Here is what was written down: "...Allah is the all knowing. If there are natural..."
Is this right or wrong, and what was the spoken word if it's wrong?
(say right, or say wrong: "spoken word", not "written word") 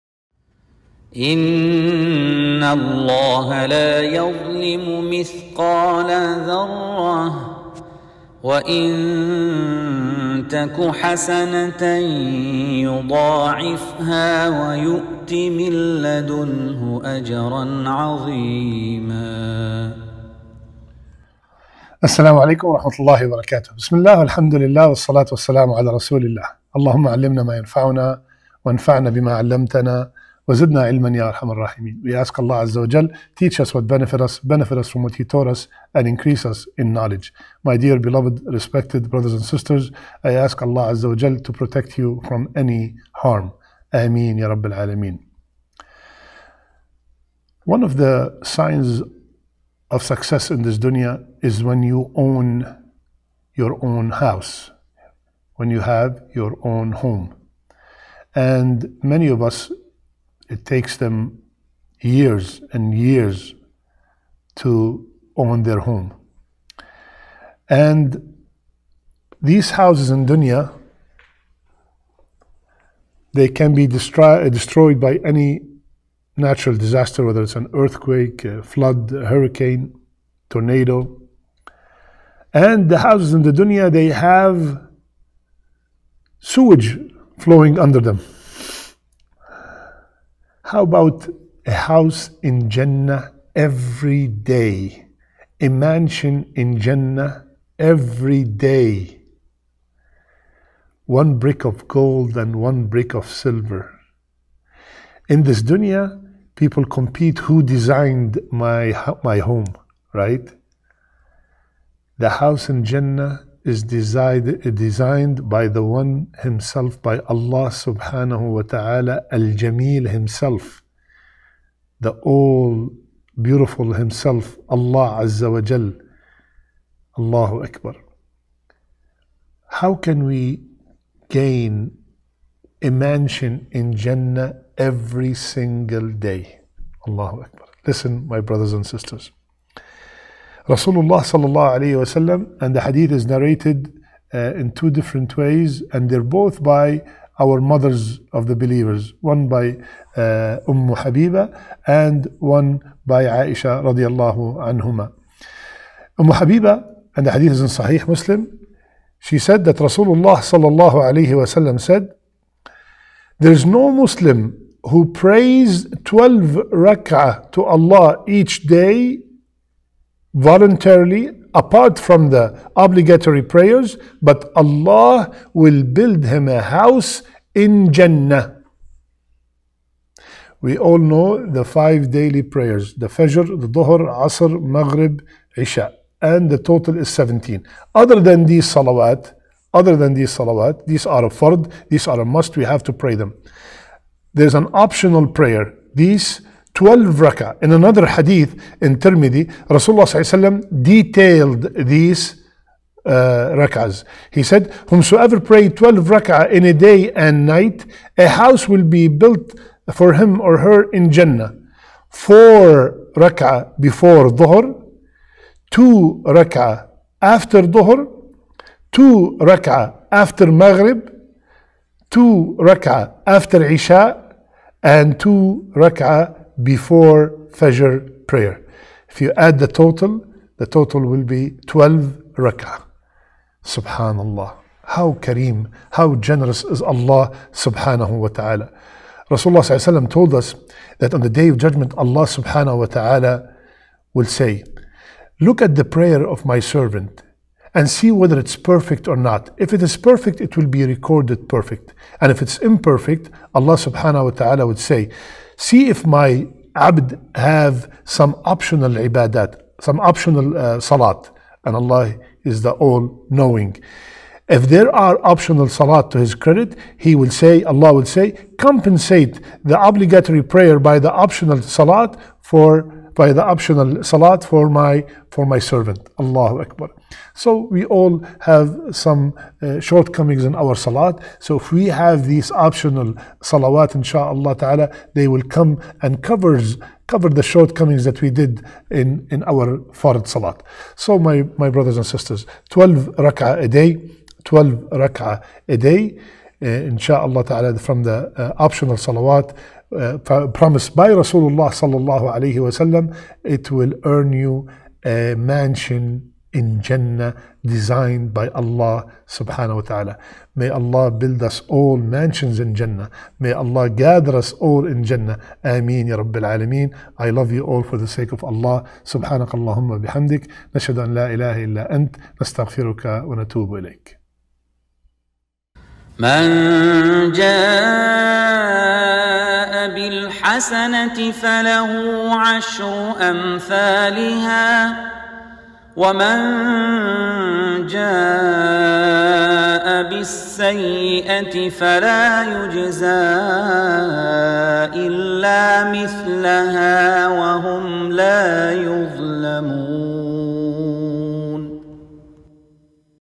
wrong: "optional", not "natural".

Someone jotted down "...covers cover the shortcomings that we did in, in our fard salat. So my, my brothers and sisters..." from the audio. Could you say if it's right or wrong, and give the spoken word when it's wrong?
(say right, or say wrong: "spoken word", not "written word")
right.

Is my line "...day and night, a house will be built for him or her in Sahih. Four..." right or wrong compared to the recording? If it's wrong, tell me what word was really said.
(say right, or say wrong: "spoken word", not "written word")
wrong: "Jannah", not "Sahih".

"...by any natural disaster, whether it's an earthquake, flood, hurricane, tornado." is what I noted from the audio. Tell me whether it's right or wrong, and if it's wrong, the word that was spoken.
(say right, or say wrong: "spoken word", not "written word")
right.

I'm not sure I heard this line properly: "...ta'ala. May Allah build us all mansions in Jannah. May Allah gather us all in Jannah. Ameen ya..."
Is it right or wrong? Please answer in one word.
right.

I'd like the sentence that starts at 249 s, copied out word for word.
If it is perfect, it will be recorded perfect.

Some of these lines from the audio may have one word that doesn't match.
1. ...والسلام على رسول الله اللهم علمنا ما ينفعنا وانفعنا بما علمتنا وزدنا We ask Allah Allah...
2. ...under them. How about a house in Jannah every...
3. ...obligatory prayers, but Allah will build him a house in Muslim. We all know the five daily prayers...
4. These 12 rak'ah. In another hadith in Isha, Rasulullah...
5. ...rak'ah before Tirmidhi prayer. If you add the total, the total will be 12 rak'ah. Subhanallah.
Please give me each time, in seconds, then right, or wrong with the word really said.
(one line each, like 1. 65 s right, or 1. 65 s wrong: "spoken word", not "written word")
1. 25 s wrong: "Azza", not "Allah"
2. 87 s right
3. 172 s wrong: "Jannah", not "Muslim"
4. 195 s wrong: "Tirmidhi", not "Isha"
5. 225 s wrong: "Fajr", not "Tirmidhi".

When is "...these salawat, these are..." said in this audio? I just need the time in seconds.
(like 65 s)
190 s.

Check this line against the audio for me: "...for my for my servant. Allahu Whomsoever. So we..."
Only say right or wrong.
wrong.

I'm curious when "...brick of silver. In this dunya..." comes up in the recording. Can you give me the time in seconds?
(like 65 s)
102 s.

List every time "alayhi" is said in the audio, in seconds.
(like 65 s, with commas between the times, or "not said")
141 s, 160 s, 302 s.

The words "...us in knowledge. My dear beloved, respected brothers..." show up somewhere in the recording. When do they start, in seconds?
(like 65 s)
36 s.